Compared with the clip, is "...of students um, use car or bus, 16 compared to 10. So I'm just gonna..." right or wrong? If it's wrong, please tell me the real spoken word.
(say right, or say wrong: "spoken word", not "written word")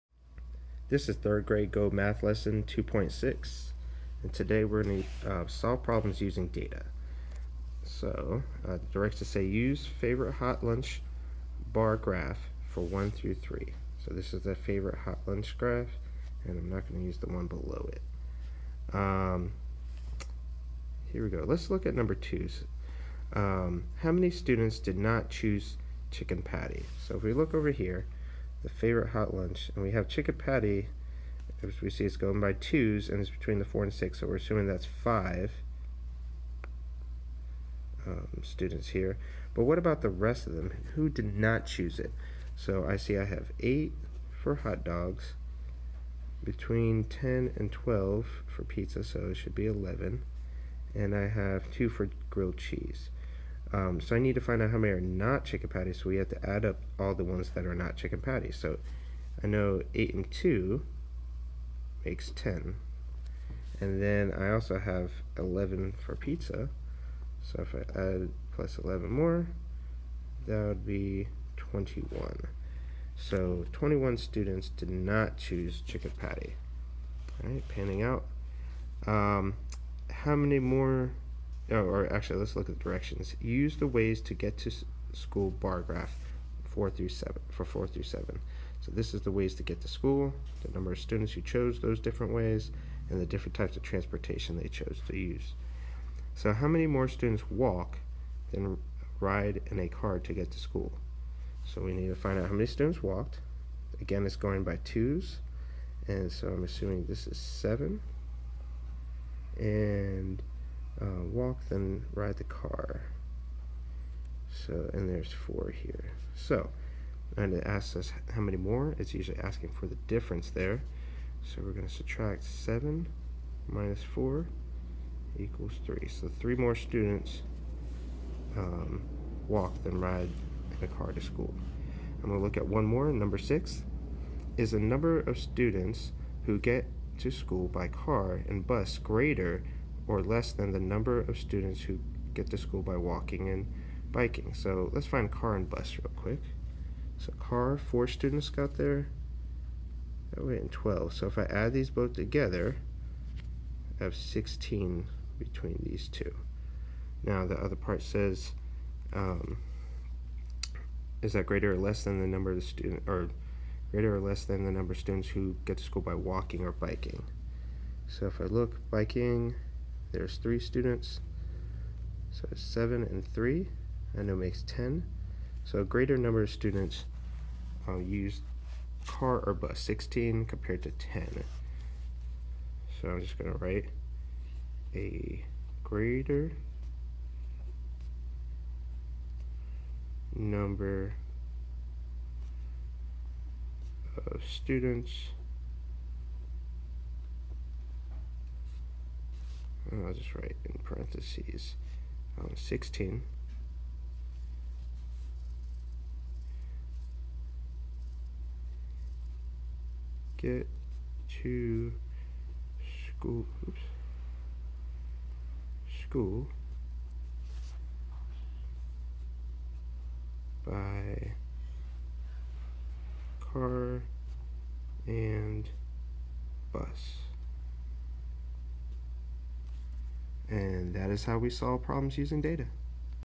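right.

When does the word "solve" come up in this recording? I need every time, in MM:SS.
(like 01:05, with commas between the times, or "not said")
00:05, 03:51.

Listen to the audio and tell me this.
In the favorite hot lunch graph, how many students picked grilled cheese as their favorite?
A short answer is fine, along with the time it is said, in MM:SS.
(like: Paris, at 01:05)
2, at 00:51.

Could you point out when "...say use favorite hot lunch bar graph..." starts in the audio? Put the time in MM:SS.
00:09.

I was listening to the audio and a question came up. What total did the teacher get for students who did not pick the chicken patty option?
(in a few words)
21.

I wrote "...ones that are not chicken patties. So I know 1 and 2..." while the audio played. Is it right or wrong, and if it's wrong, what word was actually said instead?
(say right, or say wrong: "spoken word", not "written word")
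wrong: "8", not "1".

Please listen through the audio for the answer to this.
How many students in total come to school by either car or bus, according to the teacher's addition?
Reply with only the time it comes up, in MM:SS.
02:33.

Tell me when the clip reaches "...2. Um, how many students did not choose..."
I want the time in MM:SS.
00:22.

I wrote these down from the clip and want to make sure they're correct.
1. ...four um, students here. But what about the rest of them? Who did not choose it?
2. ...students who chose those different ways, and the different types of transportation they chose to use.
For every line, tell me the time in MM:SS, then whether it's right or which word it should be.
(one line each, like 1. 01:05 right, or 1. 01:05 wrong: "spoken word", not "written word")
1. 00:34 wrong: "five", not "four"
2. 01:30 right.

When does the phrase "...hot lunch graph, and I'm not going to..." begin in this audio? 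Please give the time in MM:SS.
00:14.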